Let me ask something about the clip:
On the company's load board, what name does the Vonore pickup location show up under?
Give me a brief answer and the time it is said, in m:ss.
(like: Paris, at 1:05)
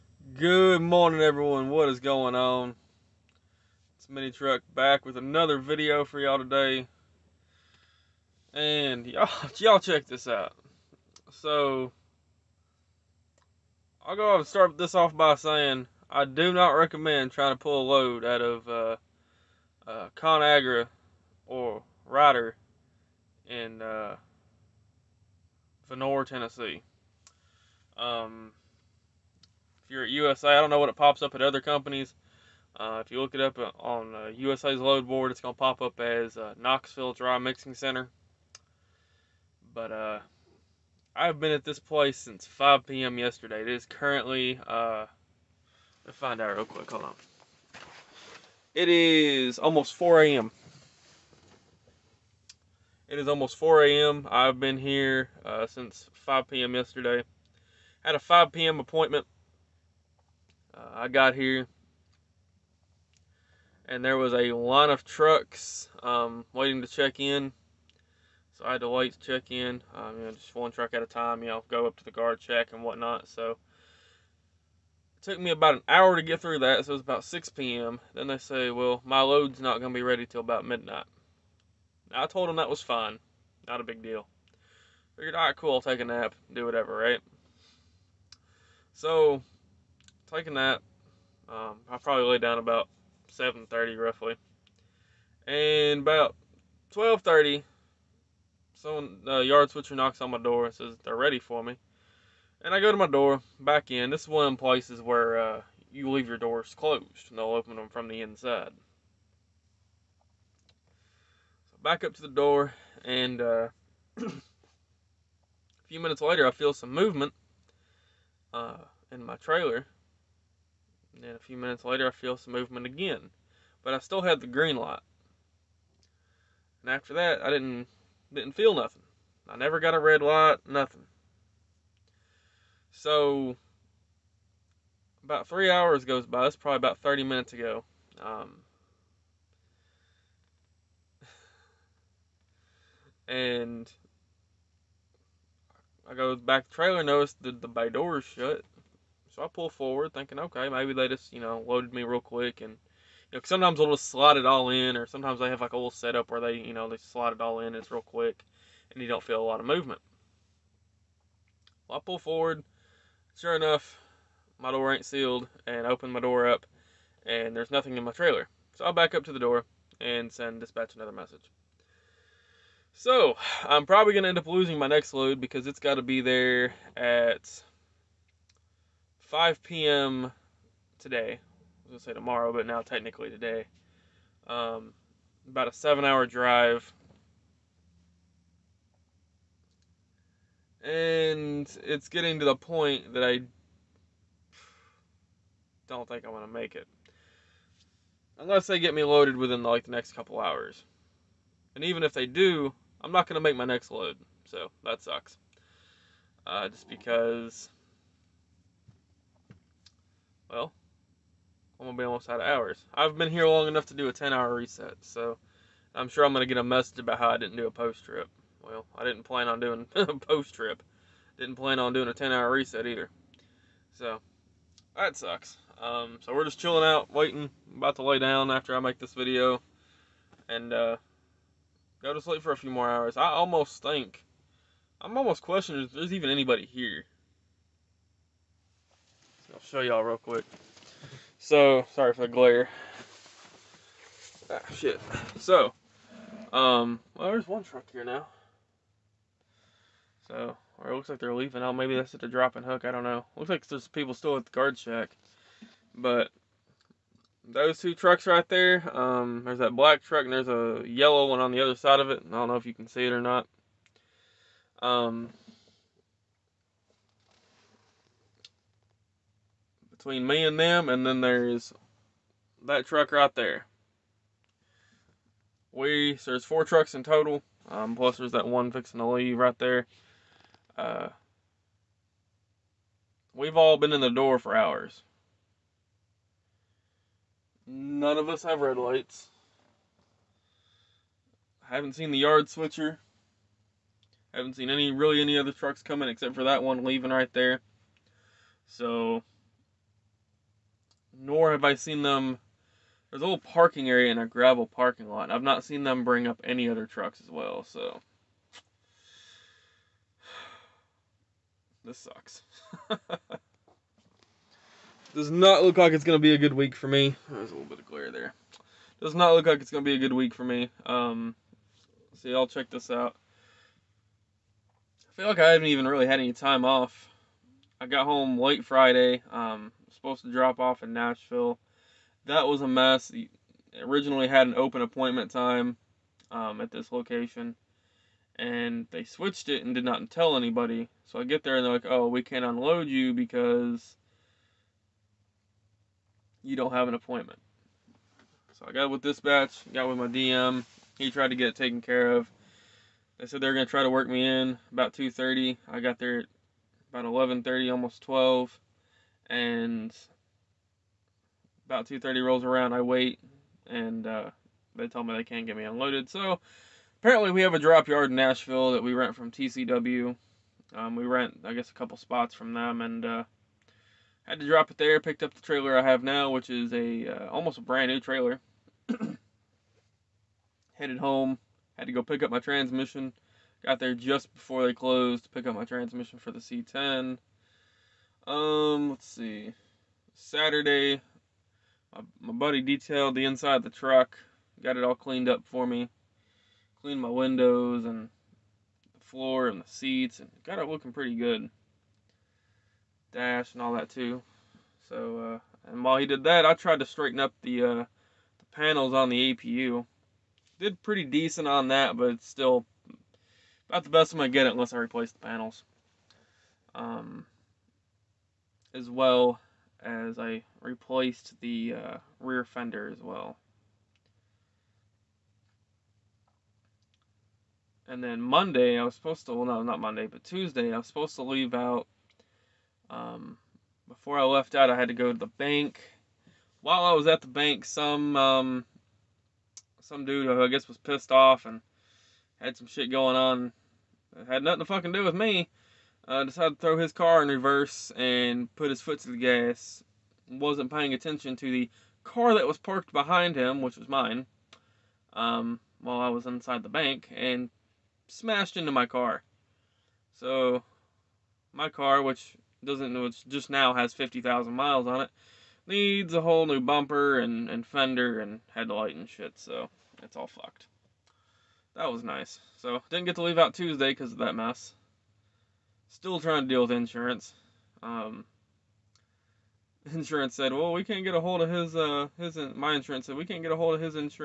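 Knoxville Dry Mixing Center, at 0:36.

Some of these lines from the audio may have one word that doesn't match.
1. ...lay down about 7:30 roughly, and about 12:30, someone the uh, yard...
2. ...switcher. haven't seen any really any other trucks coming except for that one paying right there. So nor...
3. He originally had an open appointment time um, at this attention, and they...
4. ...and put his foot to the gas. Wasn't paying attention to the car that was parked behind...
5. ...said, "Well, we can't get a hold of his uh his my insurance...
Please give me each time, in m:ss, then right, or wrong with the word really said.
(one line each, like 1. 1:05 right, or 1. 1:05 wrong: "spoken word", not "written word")
1. 1:32 right
2. 4:52 wrong: "leaving", not "paying"
3. 5:33 wrong: "location", not "attention"
4. 7:27 right
5. 8:00 right.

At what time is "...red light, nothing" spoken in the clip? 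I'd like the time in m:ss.
2:09.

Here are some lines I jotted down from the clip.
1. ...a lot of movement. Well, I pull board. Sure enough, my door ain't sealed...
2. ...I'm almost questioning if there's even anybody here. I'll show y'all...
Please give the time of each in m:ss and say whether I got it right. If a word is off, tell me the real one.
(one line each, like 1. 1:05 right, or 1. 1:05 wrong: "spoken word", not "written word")
1. 2:39 wrong: "forward", not "board"
2. 3:54 right.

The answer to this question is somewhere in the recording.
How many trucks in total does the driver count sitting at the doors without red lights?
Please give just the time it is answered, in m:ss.
4:36.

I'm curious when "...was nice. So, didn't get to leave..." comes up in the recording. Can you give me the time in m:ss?
7:51.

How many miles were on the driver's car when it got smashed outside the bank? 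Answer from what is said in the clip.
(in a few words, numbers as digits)
50,000.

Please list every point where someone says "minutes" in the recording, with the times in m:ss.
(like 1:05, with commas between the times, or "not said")
1:56, 2:01, 2:17.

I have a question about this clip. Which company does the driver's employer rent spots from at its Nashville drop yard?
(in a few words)
TCW.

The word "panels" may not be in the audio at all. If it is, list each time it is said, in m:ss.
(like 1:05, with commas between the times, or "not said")
6:48, 6:55.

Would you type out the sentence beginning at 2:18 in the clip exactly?
Um, and I go back to the trailer, notice that the bay door is shut.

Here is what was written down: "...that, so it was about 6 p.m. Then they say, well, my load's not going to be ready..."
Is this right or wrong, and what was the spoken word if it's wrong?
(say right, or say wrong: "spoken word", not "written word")
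right.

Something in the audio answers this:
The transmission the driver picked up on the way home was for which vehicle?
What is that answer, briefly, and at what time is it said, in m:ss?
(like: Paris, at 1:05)
C10, at 6:26.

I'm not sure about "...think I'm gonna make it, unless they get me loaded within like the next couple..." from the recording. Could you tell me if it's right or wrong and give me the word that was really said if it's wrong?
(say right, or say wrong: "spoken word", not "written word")
right.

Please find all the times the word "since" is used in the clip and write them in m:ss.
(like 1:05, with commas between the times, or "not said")
0:42, 0:55.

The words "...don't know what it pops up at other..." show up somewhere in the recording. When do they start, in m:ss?
0:30.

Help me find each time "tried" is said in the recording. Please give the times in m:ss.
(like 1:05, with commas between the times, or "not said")
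5:51, 6:46.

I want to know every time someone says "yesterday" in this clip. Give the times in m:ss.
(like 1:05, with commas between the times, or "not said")
0:43, 0:56.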